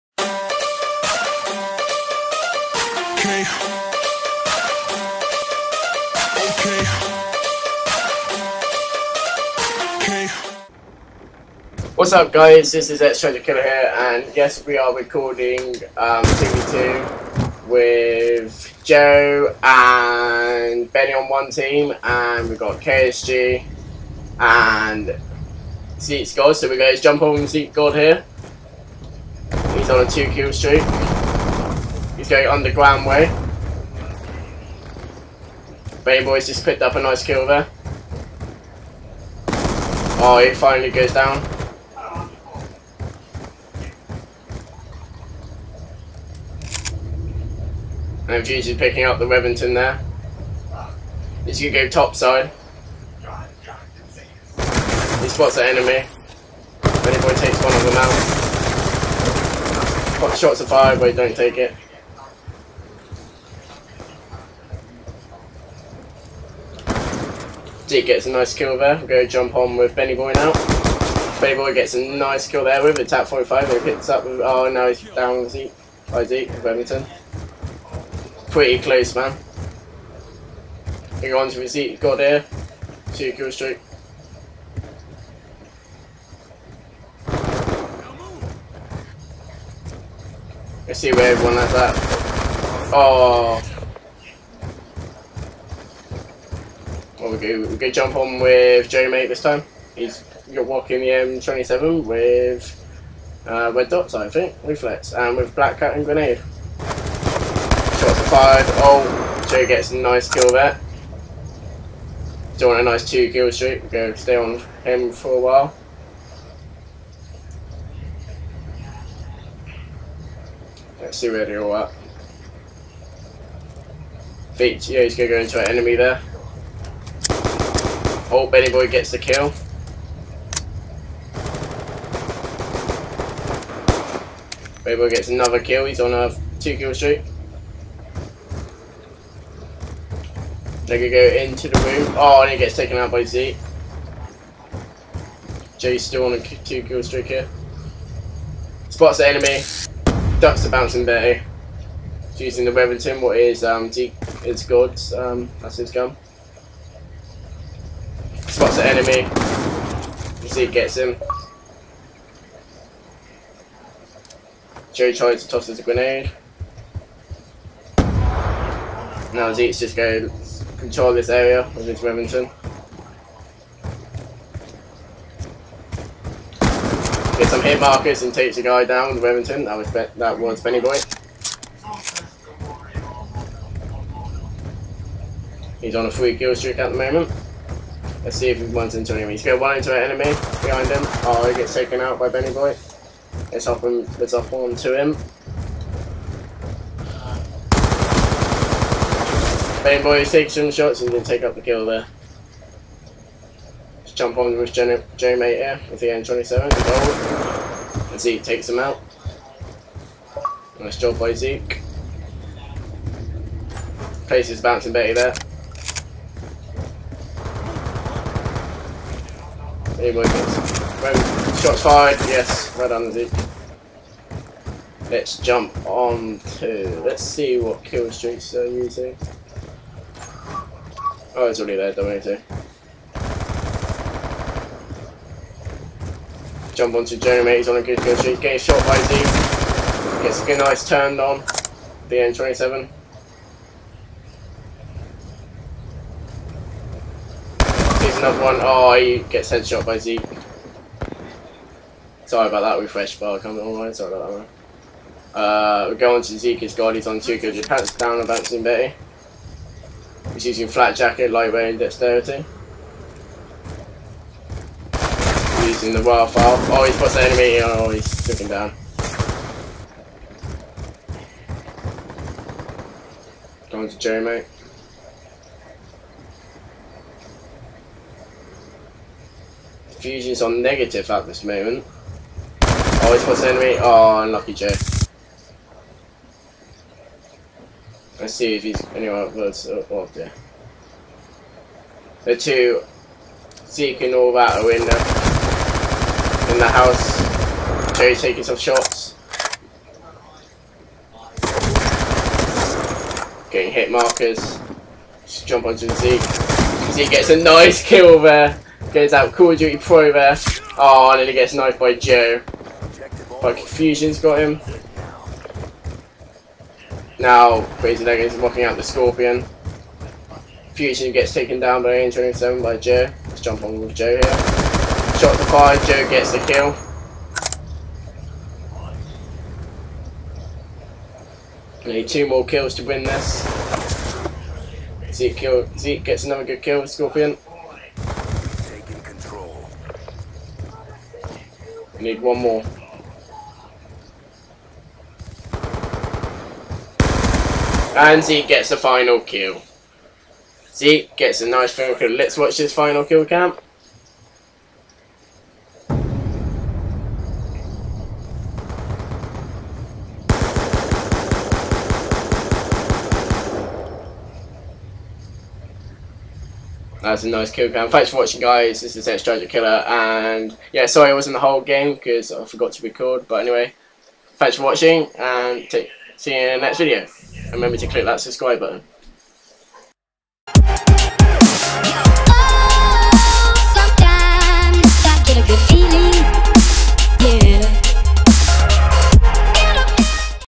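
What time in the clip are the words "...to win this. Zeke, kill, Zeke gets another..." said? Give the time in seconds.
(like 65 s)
332 s.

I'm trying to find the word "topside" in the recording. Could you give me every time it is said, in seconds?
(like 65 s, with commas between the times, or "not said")
51 s.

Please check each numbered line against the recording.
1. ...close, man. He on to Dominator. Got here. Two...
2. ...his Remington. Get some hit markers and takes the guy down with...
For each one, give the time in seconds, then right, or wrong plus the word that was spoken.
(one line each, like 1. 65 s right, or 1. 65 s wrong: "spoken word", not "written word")
1. 78 s wrong: "Zeke", not "Dominator"
2. 171 s right.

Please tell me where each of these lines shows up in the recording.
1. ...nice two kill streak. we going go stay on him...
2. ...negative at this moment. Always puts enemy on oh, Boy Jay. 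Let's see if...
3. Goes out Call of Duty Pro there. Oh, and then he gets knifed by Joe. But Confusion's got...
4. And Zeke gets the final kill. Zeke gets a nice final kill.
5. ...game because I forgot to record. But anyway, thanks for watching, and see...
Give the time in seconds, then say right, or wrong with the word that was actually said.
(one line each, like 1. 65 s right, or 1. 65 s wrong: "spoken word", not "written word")
1. 112 s right
2. 280 s wrong: "Lucky", not "Boy"
3. 308 s right
4. 347 s right
5. 371 s right.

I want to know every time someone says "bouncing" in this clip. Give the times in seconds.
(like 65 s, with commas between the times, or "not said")
150 s, 214 s, 258 s.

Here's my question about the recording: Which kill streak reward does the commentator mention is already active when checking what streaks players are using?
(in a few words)
Dominator.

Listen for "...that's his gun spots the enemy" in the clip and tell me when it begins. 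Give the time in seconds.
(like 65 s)
155 s.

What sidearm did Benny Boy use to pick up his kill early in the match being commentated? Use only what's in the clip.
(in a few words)
Tac-45.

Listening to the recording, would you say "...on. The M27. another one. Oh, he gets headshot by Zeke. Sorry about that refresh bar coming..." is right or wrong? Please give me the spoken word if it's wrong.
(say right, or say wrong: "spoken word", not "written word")
right.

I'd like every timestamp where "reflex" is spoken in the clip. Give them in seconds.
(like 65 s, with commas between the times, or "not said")
104 s.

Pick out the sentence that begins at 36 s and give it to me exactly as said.
Bay Boys just picked up a nice kill there.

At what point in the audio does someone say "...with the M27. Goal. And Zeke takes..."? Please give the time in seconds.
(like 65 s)
205 s.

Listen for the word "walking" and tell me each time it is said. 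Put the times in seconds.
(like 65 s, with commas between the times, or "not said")
100 s, 318 s.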